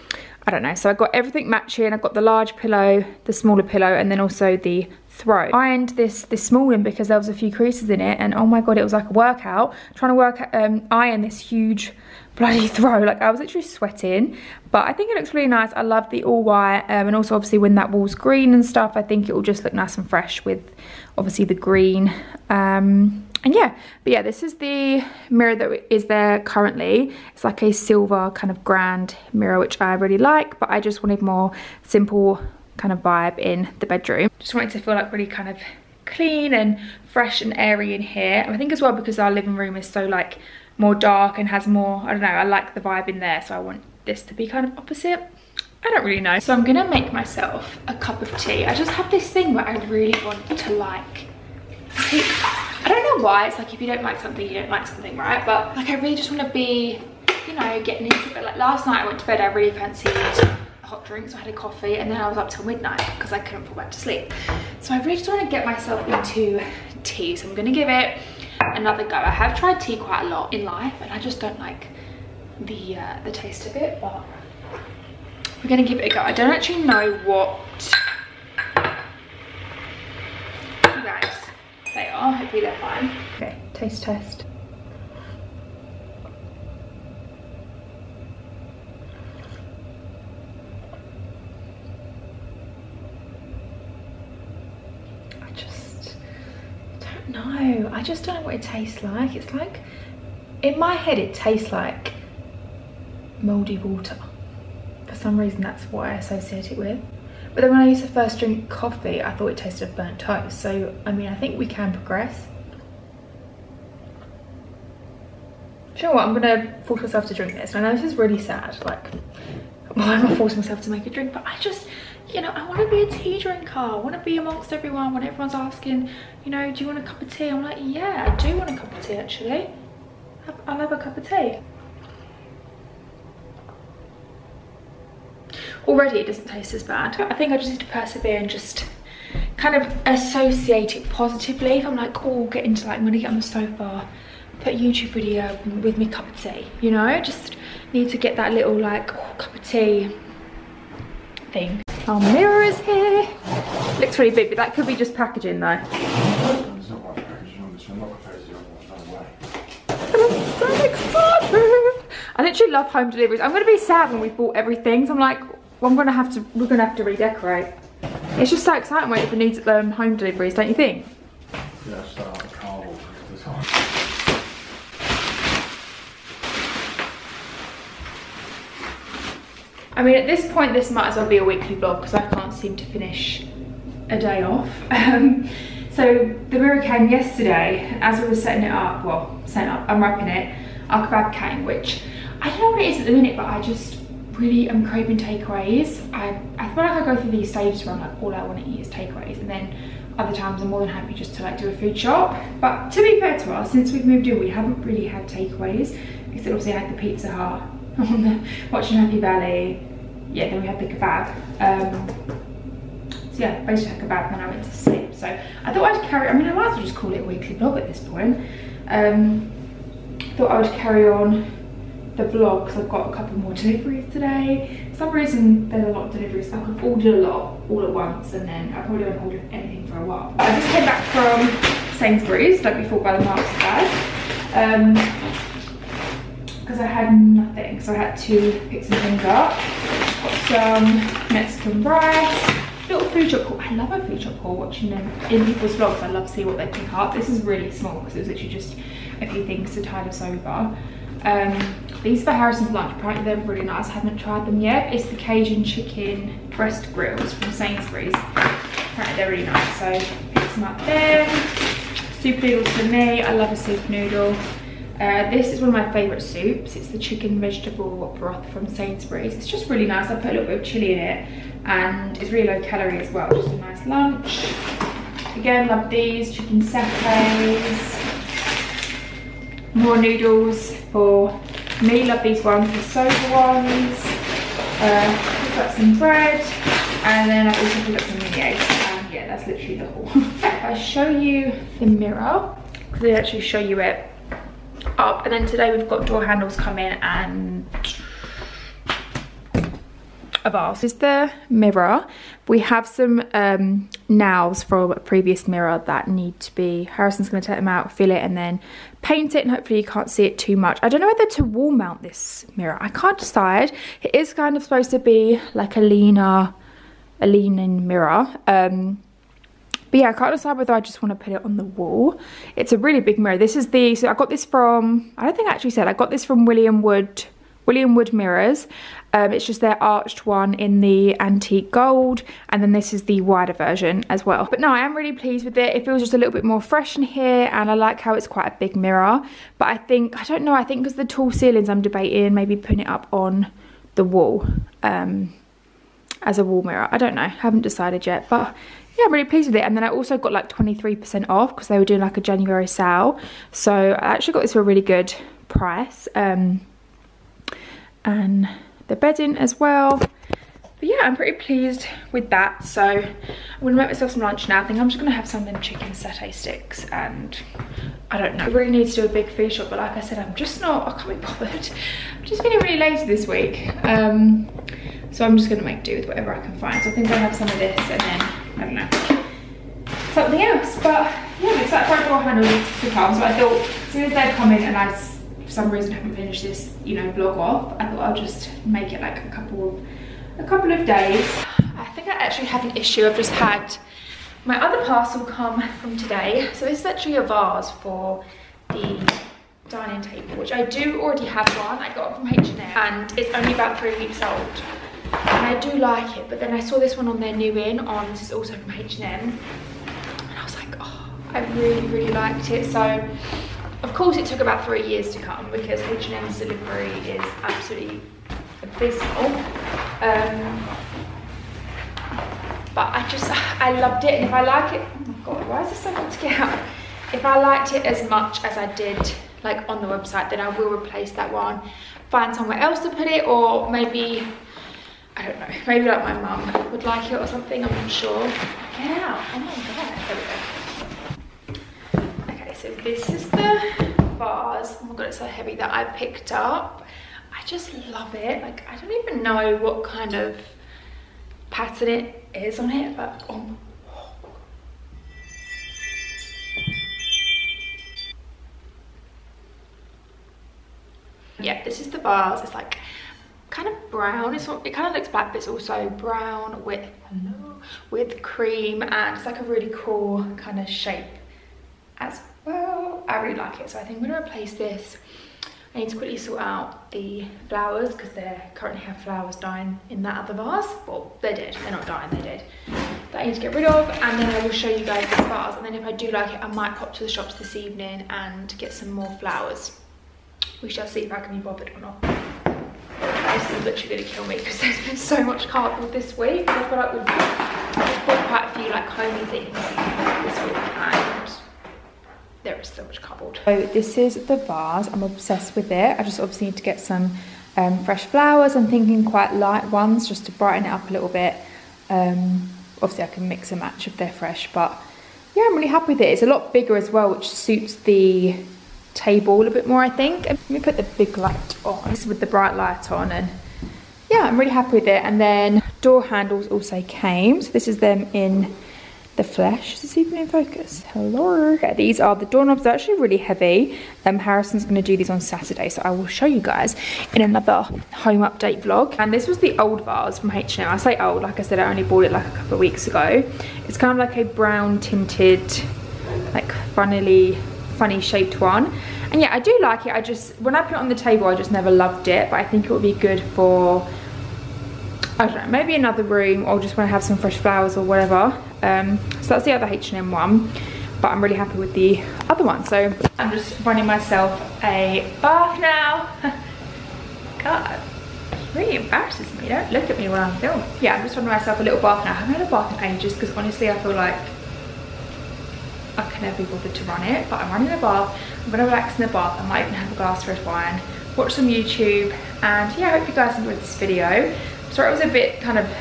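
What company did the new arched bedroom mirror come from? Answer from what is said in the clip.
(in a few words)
William Wood Mirrors.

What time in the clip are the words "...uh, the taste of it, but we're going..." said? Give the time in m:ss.
1:12.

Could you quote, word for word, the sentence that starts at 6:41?
I got it from H&M and it's only about three weeks old.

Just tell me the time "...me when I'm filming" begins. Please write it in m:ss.
9:29.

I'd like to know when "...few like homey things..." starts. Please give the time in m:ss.
8:18.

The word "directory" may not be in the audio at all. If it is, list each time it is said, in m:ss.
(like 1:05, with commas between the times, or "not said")
not said.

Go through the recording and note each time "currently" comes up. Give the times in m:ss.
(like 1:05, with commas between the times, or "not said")
0:26, 7:58.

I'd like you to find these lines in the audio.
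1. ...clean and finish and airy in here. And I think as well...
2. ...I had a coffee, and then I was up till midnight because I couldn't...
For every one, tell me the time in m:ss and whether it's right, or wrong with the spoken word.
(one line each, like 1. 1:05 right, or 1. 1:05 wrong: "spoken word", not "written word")
1. 0:36 wrong: "fresh", not "finish"
2. 1:01 right.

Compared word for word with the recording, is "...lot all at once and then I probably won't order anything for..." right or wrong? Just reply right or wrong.
right.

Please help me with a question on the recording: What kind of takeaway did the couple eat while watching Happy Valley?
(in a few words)
Pizza Hut.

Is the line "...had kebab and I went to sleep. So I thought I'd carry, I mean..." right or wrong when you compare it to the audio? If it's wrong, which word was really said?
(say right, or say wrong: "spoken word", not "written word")
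right.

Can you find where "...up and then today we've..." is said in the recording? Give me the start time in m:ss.
4:54.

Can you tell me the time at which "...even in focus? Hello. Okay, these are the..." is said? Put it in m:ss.
8:49.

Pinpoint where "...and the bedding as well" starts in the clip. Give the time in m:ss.
5:58.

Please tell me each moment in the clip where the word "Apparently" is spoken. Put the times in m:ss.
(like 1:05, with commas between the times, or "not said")
4:12, 4:18.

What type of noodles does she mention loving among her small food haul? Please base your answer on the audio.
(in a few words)
soba.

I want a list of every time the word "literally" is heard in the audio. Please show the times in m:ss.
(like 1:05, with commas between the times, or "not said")
0:13, 2:42, 4:08, 4:49, 8:13.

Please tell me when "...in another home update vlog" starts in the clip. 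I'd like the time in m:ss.
8:57.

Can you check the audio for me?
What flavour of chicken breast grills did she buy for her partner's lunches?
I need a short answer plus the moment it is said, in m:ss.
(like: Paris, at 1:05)
Cajun, at 4:15.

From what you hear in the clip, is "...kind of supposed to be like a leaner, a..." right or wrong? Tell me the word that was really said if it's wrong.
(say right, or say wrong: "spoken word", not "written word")
right.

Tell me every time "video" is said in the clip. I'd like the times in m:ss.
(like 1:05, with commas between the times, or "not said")
2:25, 9:43.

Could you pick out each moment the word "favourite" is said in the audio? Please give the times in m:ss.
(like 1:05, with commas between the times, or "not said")
4:25.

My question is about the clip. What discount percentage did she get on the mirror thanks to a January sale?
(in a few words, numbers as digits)
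23%.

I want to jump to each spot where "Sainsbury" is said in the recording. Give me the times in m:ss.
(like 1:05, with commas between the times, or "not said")
3:51, 4:17, 4:28.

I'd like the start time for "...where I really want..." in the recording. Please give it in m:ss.
0:49.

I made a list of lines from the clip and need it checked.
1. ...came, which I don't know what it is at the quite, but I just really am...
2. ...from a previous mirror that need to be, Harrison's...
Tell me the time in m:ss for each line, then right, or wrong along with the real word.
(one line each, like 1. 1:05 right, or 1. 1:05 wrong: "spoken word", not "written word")
1. 3:11 wrong: "minute", not "quite"
2. 5:04 right.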